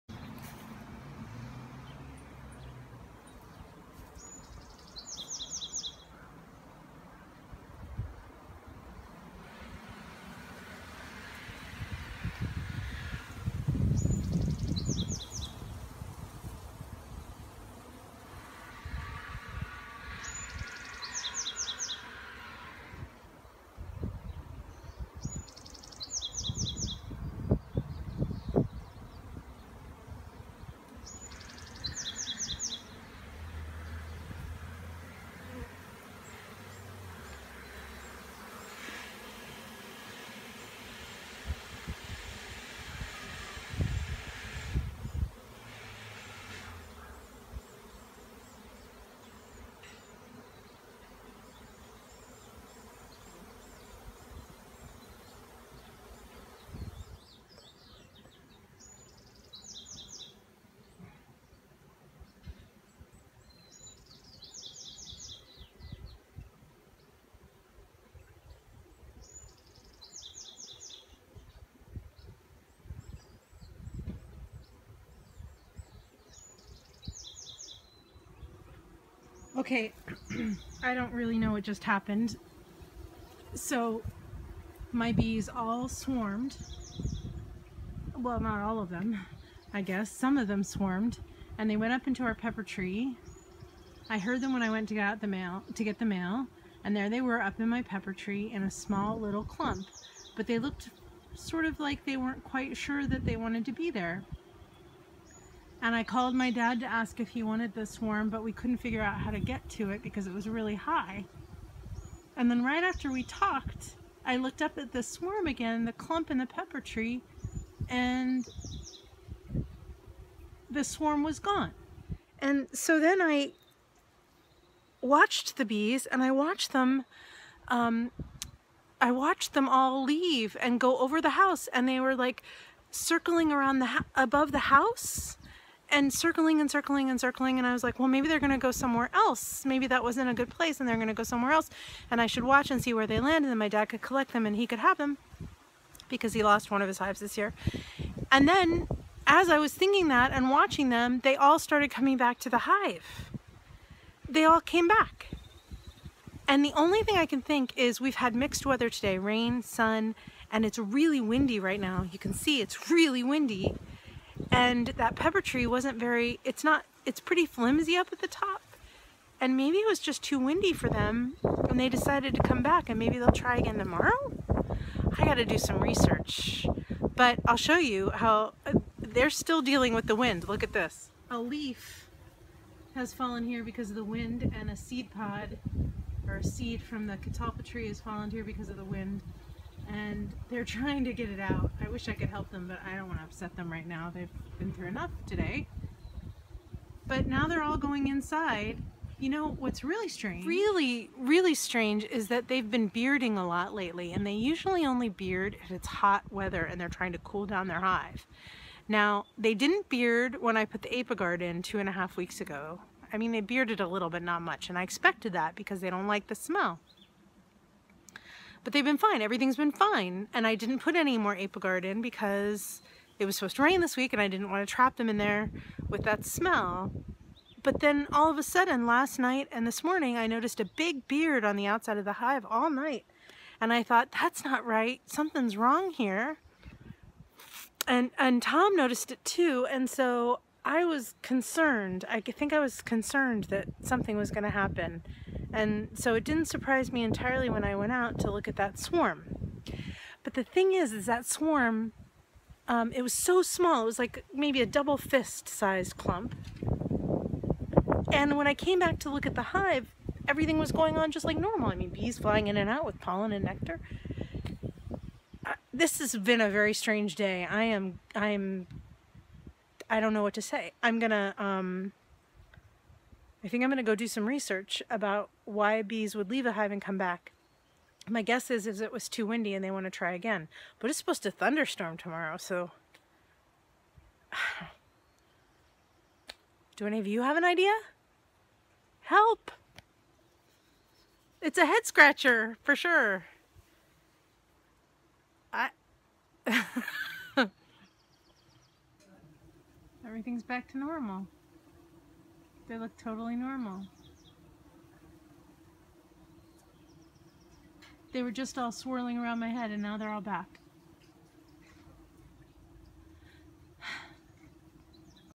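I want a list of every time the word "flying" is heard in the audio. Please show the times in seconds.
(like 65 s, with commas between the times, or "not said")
262 s.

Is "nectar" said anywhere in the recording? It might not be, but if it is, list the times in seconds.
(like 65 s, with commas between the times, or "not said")
263 s.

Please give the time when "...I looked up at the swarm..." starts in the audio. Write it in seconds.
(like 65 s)
114 s.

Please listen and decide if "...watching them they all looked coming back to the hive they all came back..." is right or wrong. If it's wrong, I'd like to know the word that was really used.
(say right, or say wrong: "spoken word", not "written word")
wrong: "started", not "looked".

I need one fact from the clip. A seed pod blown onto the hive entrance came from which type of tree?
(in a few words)
Catalpa.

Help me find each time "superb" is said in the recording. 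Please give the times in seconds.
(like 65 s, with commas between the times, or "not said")
not said.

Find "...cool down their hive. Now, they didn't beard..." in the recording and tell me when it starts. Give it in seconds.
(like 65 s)
207 s.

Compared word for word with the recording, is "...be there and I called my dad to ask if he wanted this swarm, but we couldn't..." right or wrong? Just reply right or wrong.
right.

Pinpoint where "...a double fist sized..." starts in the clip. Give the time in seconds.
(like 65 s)
254 s.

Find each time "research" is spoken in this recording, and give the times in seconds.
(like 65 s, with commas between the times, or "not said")
175 s, 274 s.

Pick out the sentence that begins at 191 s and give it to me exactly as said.
I wish I could help them, but I don't want to upset them right now.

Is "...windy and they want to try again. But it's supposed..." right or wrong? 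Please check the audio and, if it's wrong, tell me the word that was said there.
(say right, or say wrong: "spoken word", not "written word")
right.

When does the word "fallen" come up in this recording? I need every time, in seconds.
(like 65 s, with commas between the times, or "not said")
183 s, 187 s.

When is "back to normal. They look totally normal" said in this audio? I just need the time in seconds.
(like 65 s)
300 s.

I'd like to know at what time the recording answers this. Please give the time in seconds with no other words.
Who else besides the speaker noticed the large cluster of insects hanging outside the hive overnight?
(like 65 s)
238 s.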